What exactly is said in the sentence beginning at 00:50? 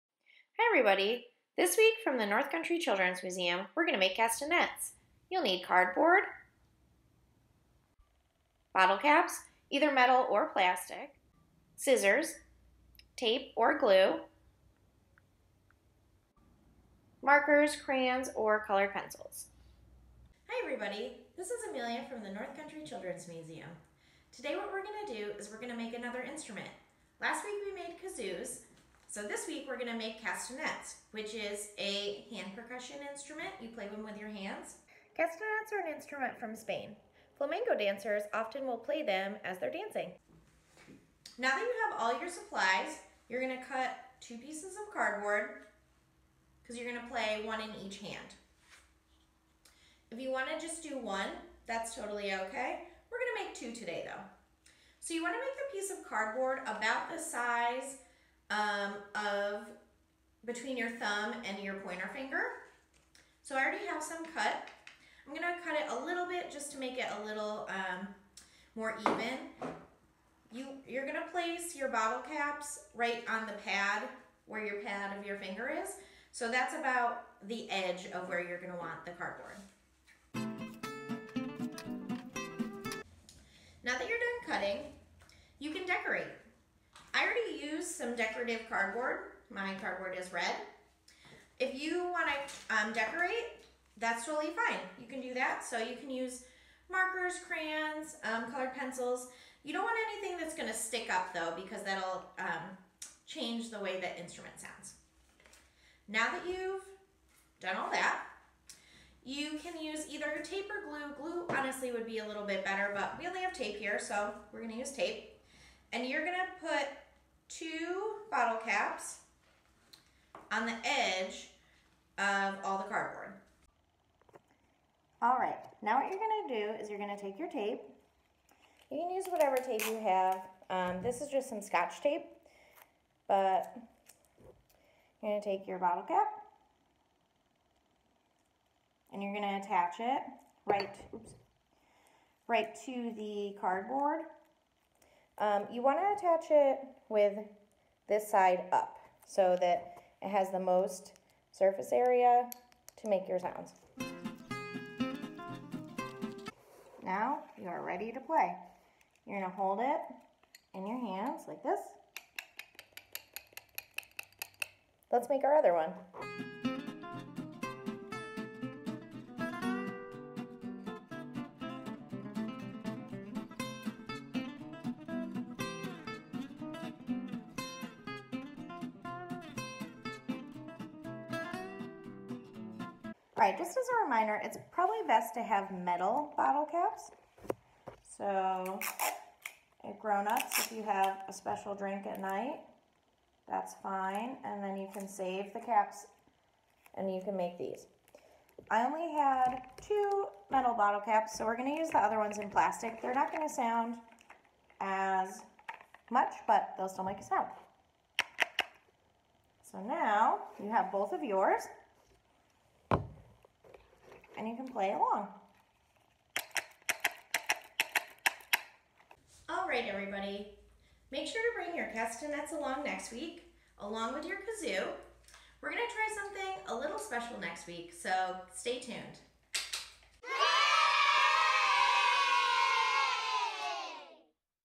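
If you wanna just do one, that's totally okay.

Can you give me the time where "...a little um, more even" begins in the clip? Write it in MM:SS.
01:07.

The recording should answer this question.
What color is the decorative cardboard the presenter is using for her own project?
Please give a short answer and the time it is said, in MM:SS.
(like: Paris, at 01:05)
red, at 01:30.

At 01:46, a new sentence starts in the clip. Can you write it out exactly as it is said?
Now that you've done all that, you can use either tape or glue.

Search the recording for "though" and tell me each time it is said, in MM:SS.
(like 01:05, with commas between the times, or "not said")
00:54, 01:41.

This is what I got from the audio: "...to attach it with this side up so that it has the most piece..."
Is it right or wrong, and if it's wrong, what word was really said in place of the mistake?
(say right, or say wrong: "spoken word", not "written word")
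wrong: "surface", not "piece".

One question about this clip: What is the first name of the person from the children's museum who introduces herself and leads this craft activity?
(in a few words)
Amelia.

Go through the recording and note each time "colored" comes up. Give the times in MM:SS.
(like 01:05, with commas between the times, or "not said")
00:18, 01:38.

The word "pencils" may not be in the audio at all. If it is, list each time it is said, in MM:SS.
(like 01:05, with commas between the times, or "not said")
00:18, 01:38.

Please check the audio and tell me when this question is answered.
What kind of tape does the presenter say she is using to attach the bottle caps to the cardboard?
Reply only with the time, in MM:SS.
02:11.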